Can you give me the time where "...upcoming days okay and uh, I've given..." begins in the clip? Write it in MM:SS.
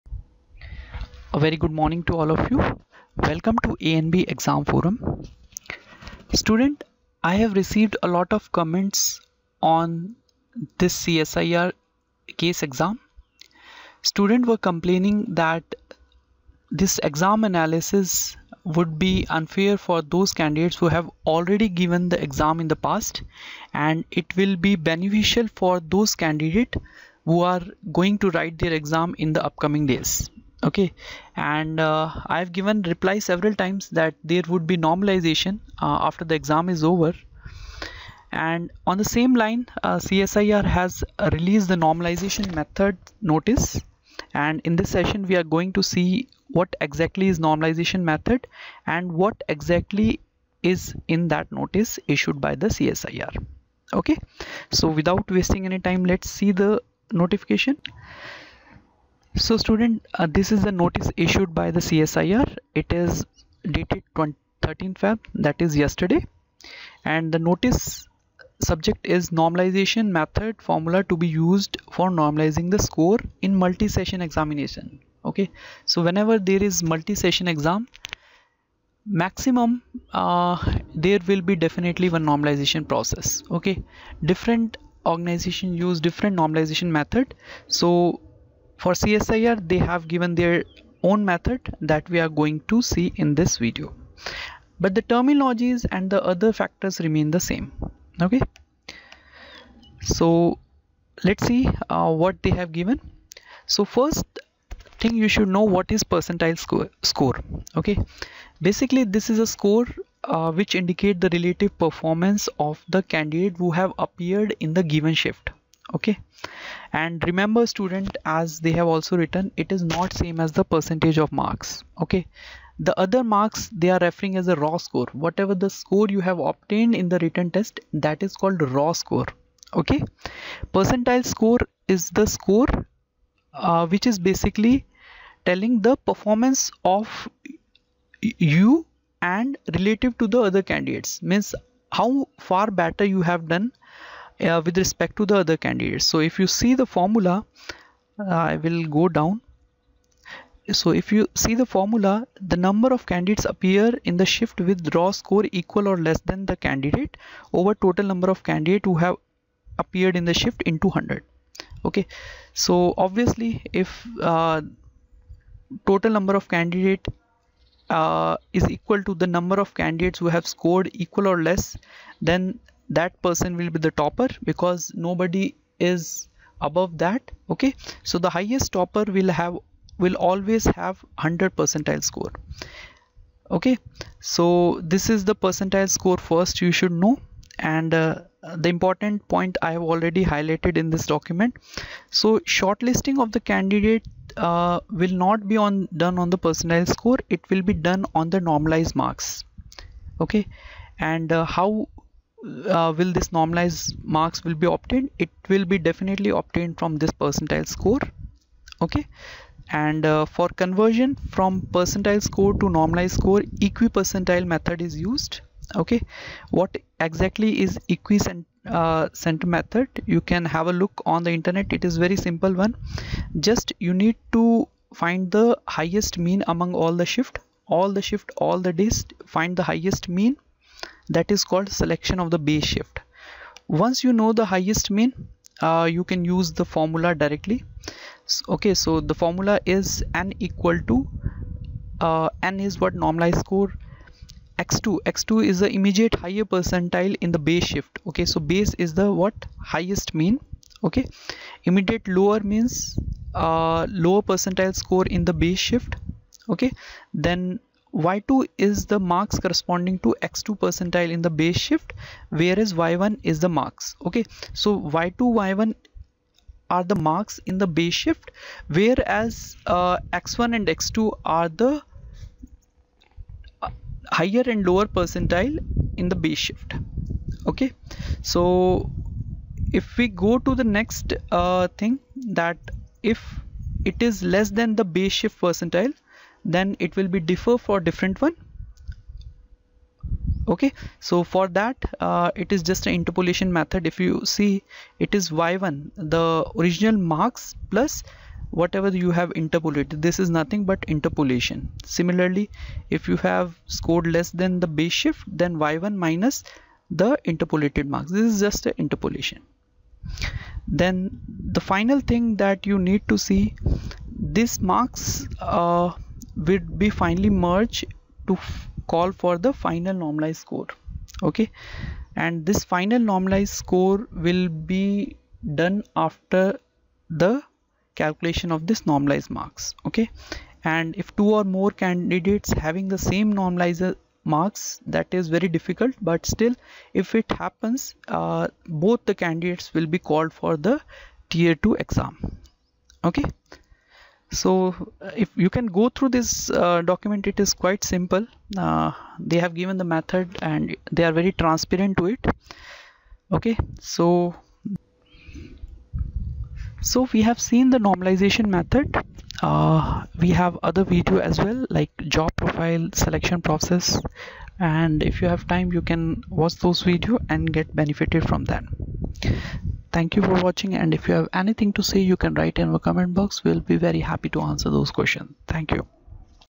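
00:29.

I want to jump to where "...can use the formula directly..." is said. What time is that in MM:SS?
03:56.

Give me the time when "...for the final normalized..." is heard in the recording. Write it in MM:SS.
05:19.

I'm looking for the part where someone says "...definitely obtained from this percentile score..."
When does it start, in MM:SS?
03:25.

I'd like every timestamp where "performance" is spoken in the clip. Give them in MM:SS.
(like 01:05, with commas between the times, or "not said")
01:51, 02:16.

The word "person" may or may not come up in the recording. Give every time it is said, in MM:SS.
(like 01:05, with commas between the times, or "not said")
02:53.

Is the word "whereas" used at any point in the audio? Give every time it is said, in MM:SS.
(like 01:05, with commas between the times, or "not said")
04:22, 04:28.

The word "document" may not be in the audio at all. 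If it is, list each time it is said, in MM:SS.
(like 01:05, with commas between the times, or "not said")
03:11, 05:46.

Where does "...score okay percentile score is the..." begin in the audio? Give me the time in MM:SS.
02:09.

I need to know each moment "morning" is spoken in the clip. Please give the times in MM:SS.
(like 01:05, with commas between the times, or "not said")
00:01.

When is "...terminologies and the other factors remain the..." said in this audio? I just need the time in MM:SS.
01:35.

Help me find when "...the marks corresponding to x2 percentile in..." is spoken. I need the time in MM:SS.
04:18.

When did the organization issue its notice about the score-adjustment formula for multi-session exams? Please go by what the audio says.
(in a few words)
13 Feb.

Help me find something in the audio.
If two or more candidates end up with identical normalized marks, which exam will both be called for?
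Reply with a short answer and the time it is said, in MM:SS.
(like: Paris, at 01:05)
tier 2 exam, at 05:41.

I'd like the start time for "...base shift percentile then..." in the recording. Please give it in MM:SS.
04:44.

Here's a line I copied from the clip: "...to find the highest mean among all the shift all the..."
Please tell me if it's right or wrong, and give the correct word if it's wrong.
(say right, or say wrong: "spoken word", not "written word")
right.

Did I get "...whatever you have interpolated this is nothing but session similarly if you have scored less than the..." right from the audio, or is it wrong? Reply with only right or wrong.
wrong.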